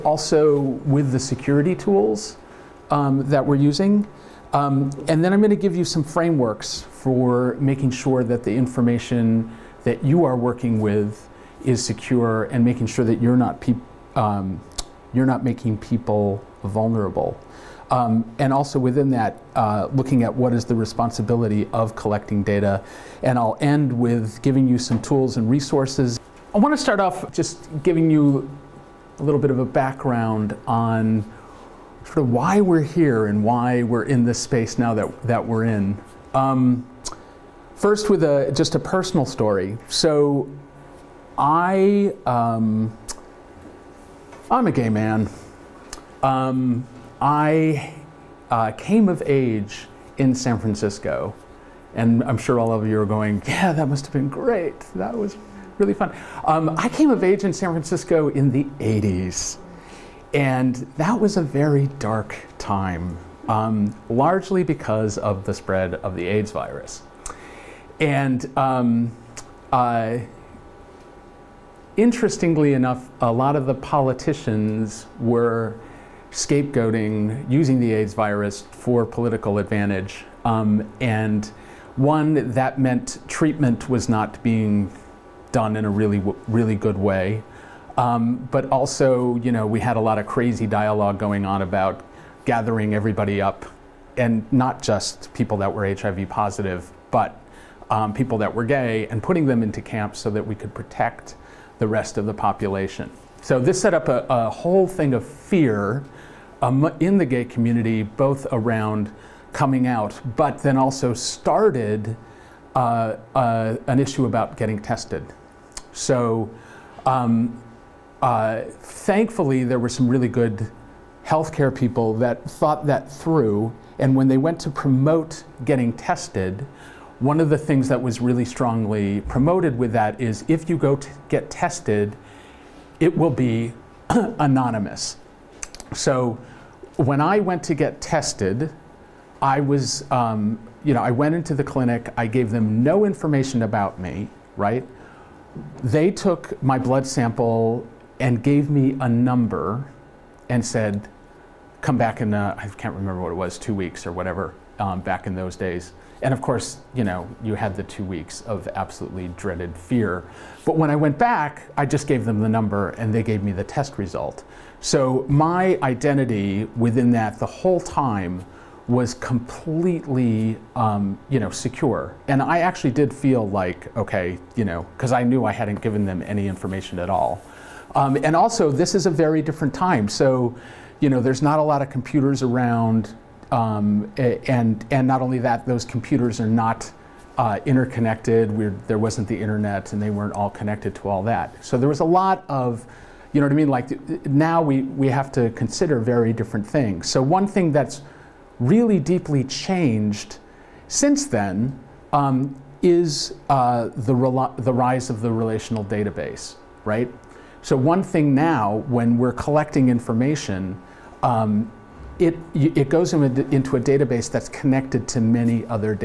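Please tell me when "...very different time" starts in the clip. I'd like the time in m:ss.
2:59.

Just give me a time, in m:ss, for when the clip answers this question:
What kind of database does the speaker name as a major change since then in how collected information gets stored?
3:25.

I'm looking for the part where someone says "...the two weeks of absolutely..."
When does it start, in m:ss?
2:37.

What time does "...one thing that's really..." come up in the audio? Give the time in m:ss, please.
3:17.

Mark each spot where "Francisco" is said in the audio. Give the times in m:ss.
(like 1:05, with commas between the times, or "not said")
0:50, 0:57.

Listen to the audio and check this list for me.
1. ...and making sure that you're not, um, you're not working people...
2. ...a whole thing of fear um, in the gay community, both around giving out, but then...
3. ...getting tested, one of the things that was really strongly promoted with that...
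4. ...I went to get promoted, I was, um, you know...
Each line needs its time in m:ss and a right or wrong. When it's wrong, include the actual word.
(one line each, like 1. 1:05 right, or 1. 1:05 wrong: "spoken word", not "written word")
1. 0:12 wrong: "making", not "working"
2. 1:44 wrong: "coming", not "giving"
3. 2:05 right
4. 2:17 wrong: "tested", not "promoted".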